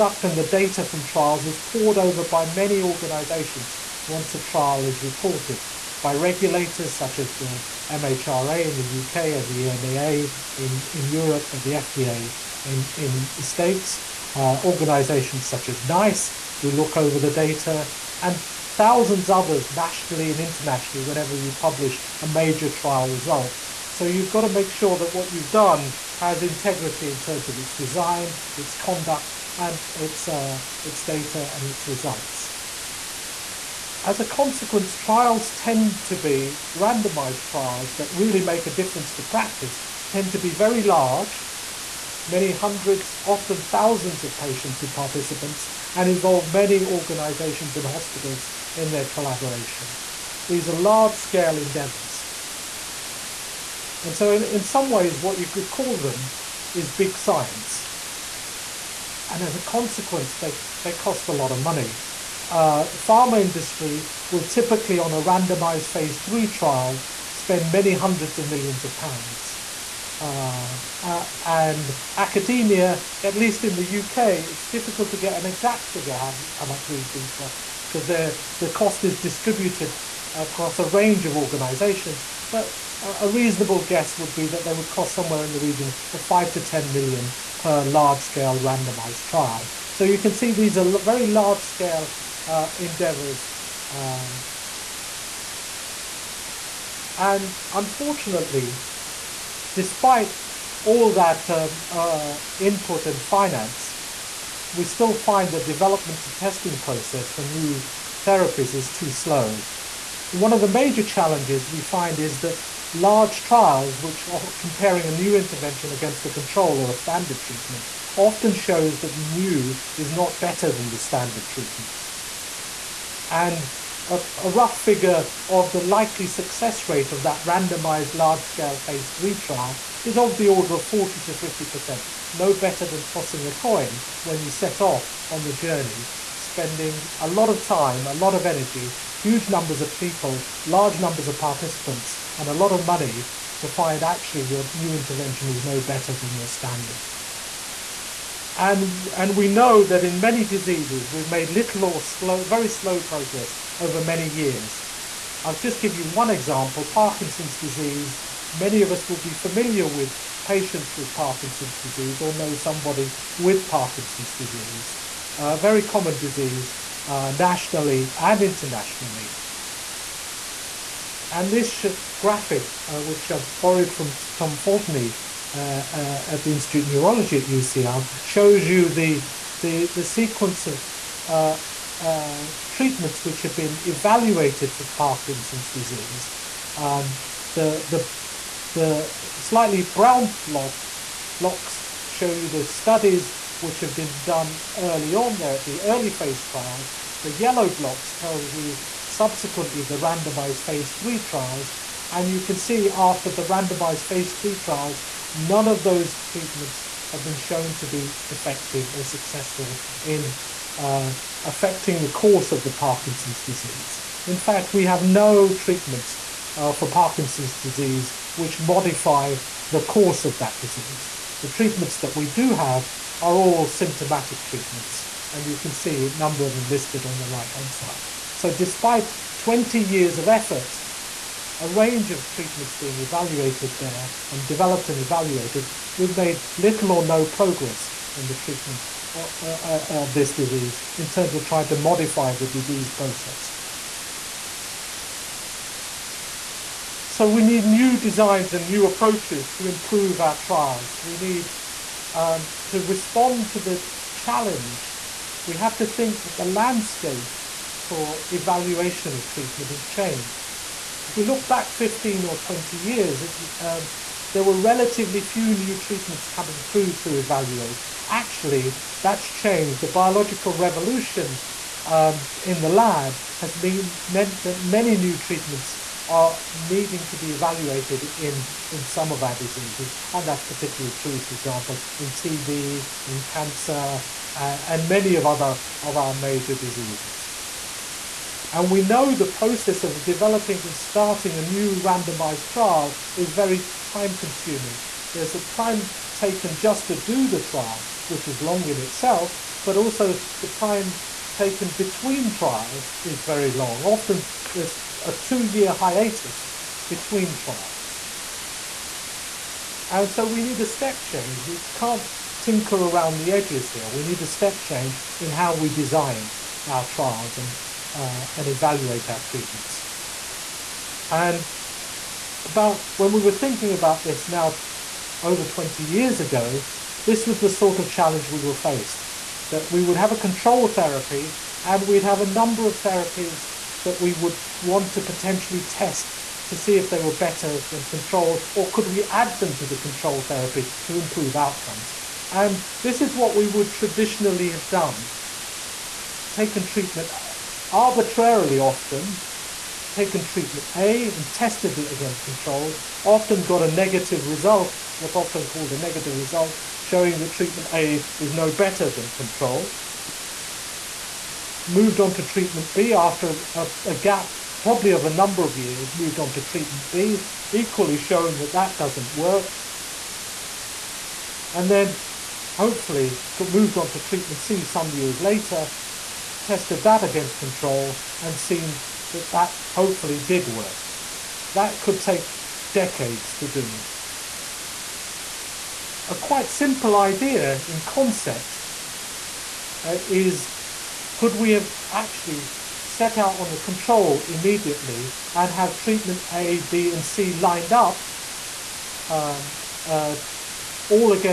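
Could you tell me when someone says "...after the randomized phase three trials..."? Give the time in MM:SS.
03:22.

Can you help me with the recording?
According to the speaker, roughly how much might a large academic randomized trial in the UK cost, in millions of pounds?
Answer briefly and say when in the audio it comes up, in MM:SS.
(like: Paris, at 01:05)
5 to 10 million, at 01:26.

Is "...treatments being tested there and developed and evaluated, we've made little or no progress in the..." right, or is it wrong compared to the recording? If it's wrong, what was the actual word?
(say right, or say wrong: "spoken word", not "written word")
wrong: "evaluated", not "tested".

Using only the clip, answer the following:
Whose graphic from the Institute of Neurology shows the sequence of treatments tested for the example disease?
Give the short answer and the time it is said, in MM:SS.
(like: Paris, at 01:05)
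Tom Foltynie, at 02:54.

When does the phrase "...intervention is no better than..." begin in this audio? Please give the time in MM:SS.
02:24.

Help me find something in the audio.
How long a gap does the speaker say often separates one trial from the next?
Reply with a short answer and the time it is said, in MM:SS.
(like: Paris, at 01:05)
2 years, at 05:05.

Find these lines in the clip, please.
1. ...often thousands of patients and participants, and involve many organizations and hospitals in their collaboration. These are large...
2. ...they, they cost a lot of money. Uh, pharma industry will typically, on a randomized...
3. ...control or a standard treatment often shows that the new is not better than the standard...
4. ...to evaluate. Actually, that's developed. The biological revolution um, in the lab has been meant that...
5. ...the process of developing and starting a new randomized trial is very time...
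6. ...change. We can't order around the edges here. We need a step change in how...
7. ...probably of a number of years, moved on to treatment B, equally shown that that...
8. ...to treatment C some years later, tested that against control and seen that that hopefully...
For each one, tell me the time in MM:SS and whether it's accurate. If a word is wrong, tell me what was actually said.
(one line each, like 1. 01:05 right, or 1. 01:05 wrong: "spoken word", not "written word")
1. 00:43 right
2. 01:00 right
3. 01:56 right
4. 04:26 wrong: "changed", not "developed"
5. 04:49 right
6. 05:11 wrong: "tinker", not "order"
7. 06:04 right
8. 06:13 right.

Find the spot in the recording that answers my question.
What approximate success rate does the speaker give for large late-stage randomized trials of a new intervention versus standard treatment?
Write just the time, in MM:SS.
02:10.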